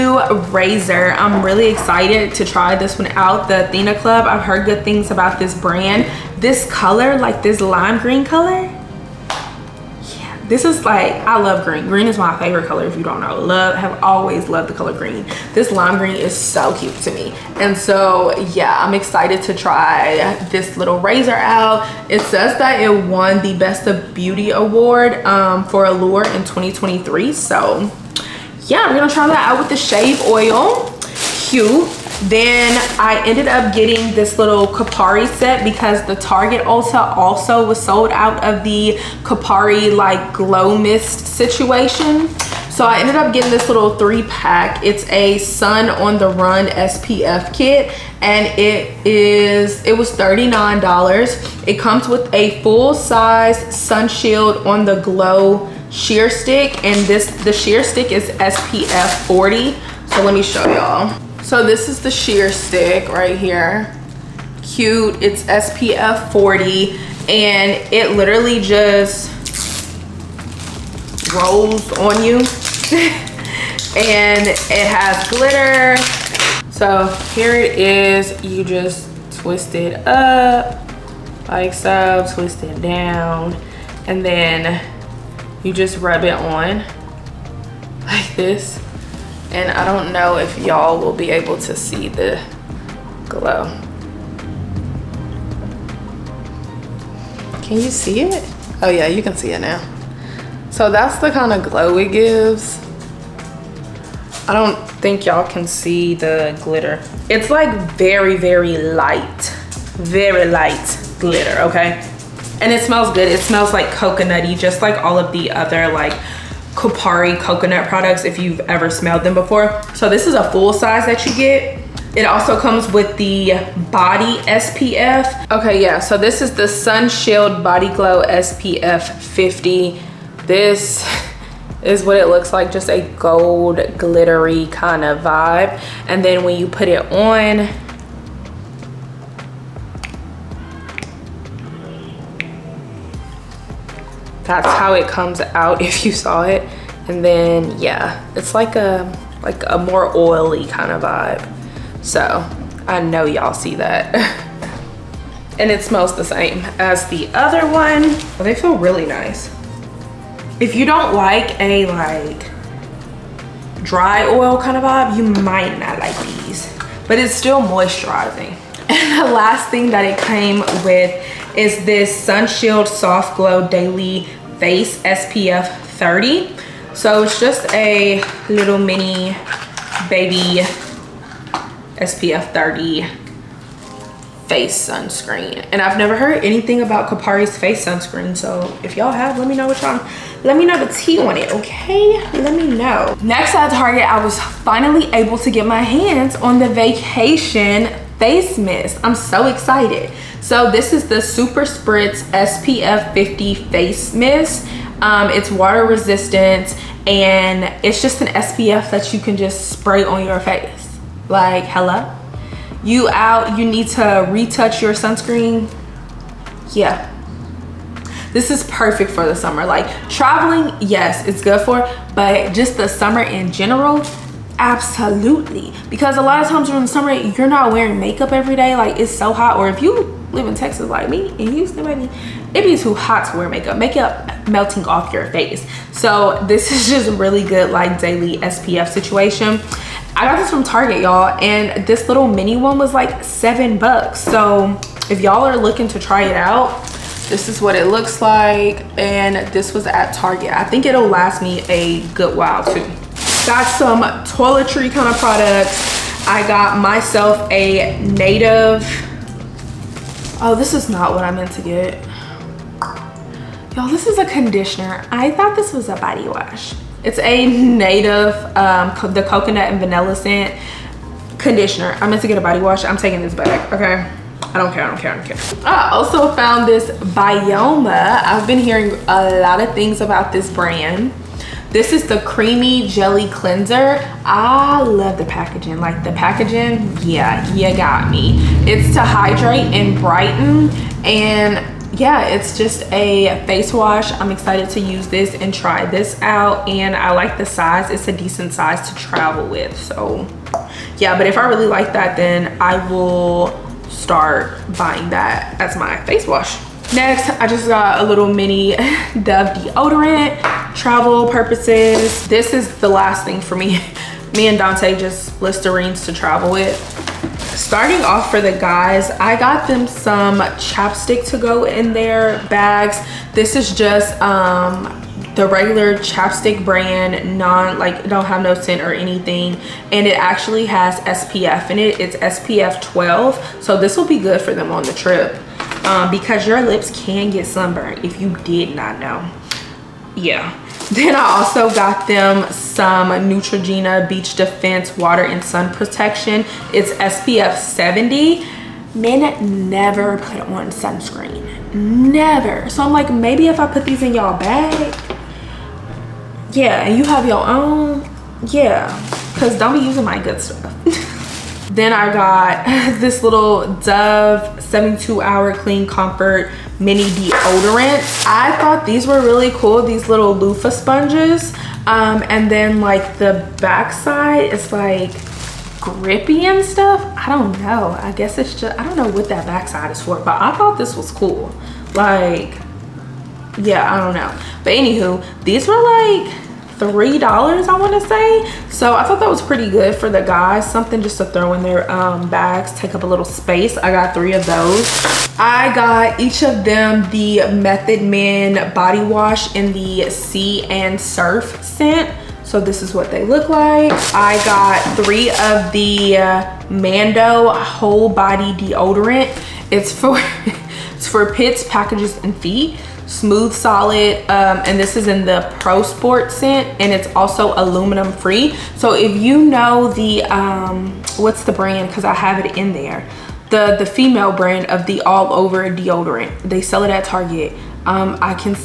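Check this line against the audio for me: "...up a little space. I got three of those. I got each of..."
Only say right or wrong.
right.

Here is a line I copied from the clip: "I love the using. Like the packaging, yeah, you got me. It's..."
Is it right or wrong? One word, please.
wrong.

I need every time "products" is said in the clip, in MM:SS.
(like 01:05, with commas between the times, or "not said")
01:57, 04:15.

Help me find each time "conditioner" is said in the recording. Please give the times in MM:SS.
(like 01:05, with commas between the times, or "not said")
04:24, 04:31.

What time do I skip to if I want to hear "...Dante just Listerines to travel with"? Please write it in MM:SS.
05:14.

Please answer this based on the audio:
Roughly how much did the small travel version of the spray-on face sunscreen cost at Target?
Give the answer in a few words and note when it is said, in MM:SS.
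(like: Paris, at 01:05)
$7, at 04:03.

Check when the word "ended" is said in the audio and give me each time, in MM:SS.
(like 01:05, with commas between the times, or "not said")
00:33, 00:43.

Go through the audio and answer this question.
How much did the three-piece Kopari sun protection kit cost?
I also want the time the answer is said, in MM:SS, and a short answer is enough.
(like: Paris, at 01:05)
$39, at 00:50.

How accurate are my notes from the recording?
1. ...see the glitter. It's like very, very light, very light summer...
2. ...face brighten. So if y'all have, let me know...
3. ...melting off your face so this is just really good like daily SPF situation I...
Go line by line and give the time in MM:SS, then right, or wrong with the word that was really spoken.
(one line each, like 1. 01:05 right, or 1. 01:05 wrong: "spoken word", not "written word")
1. 01:45 wrong: "glitter", not "summer"
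2. 03:07 wrong: "sunscreen", not "brighten"
3. 03:54 right.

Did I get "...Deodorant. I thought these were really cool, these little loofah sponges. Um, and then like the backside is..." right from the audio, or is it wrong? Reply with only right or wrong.
right.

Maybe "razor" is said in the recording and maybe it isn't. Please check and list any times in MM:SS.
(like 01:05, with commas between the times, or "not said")
00:00, 00:20.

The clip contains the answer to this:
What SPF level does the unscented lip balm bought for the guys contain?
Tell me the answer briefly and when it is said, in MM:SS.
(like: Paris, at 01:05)
SPF 12, at 05:32.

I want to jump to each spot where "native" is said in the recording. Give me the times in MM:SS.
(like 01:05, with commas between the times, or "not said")
04:18, 04:27.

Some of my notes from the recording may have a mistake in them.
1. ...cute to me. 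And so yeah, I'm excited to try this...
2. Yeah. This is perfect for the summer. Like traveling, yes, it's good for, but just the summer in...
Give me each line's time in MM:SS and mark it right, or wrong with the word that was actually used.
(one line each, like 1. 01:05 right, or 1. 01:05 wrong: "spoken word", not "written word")
1. 00:16 right
2. 03:36 right.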